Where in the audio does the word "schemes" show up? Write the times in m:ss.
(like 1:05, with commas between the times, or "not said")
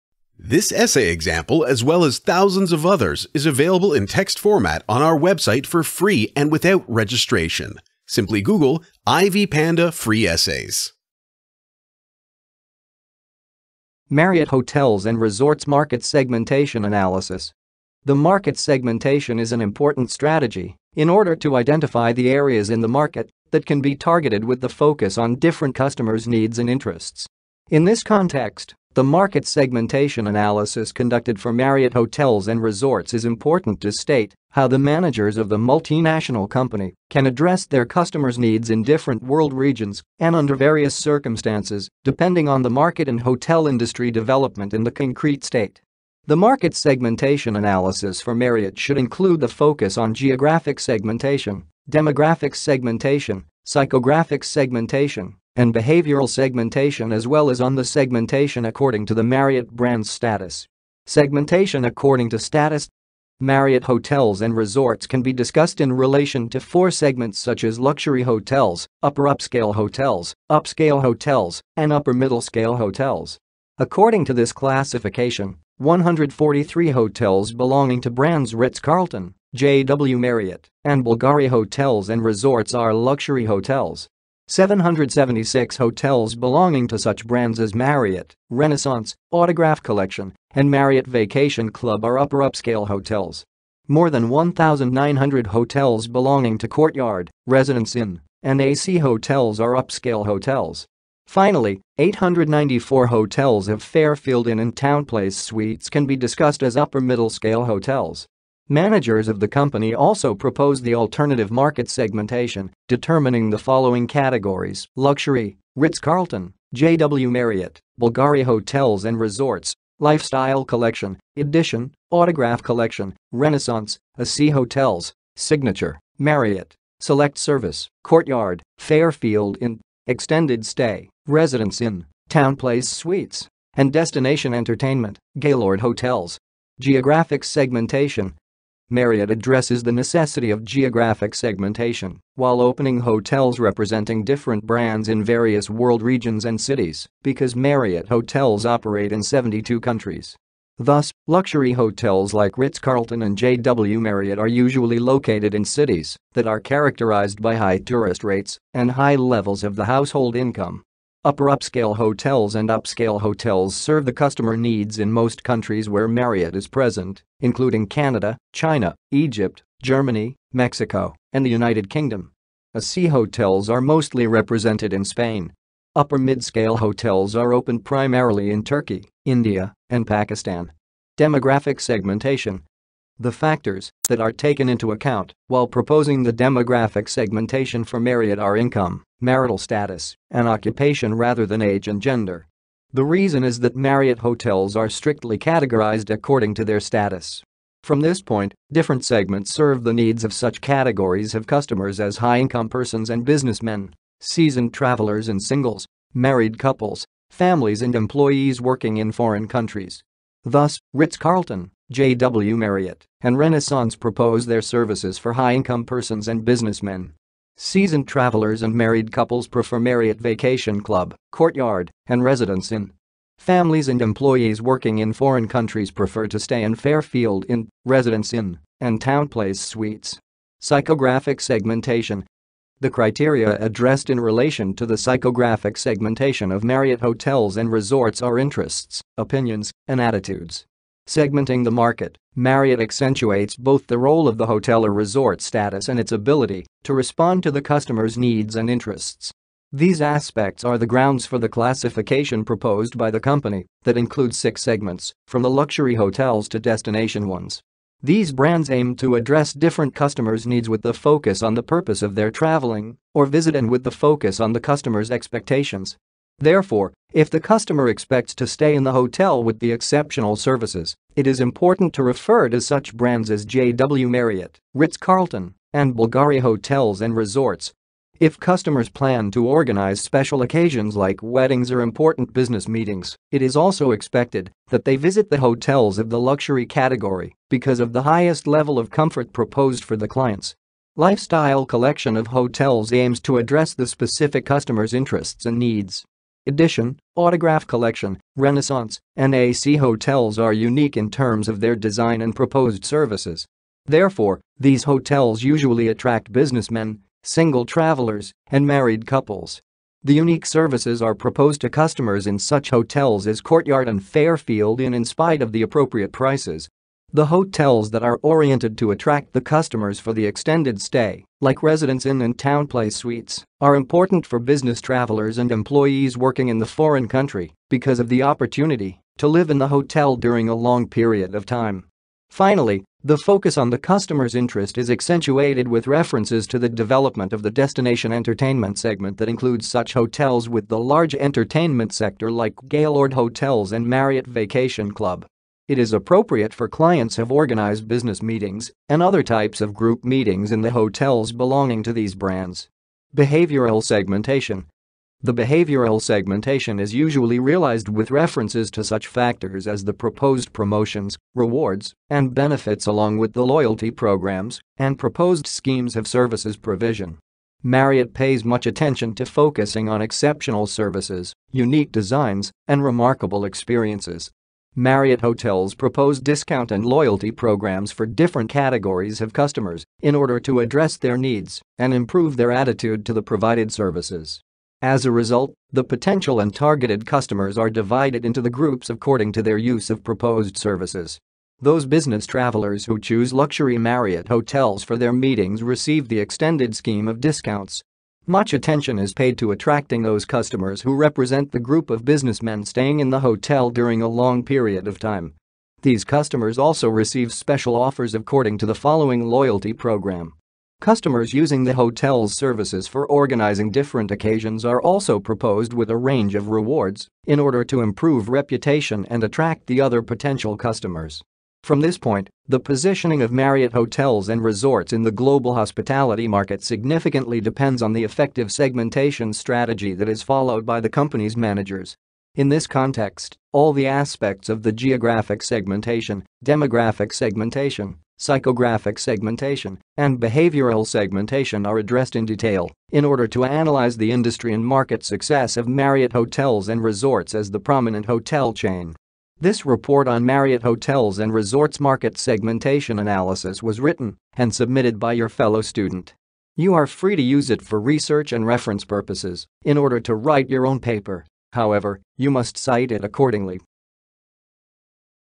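6:05, 6:36.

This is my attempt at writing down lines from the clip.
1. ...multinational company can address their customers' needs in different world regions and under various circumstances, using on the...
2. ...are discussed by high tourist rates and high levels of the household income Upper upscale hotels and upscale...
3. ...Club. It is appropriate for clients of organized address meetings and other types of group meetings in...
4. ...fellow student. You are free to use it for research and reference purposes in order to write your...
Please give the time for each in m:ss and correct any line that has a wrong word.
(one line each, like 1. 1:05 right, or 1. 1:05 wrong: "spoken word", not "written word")
1. 0:35 wrong: "depending", not "using"
2. 2:36 wrong: "characterized", not "discussed"
3. 5:44 wrong: "business", not "address"
4. 7:35 right.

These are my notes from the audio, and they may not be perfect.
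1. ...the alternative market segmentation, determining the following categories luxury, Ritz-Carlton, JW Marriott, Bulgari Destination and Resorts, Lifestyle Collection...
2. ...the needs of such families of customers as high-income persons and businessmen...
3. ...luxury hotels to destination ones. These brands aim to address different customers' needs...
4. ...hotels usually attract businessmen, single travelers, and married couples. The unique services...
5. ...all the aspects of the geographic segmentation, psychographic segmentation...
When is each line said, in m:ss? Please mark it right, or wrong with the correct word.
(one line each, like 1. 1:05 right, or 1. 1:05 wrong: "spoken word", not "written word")
1. 1:50 wrong: "Hotels", not "Destination"
2. 3:19 wrong: "categories", not "families"
3. 4:15 right
4. 5:04 right
5. 7:13 wrong: "demographic", not "psychographic".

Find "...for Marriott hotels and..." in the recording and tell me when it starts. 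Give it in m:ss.
0:31.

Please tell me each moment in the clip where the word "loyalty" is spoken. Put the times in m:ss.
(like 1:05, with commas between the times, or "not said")
6:03, 6:16, 6:49.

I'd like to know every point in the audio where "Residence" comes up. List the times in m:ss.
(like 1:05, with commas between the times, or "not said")
1:37, 2:11, 3:42, 3:47, 5:21.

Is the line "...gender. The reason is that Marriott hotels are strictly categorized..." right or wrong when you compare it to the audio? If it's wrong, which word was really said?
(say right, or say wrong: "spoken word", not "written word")
right.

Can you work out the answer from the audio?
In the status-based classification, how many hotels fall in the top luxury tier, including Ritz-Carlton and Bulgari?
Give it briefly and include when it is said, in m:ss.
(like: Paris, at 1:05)
143, at 1:15.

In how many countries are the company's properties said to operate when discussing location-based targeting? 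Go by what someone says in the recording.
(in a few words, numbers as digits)
72.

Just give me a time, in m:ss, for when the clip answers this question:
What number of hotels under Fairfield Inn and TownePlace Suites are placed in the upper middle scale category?
1:41.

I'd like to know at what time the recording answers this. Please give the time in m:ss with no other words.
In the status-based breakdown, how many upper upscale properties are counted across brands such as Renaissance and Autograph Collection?
1:24.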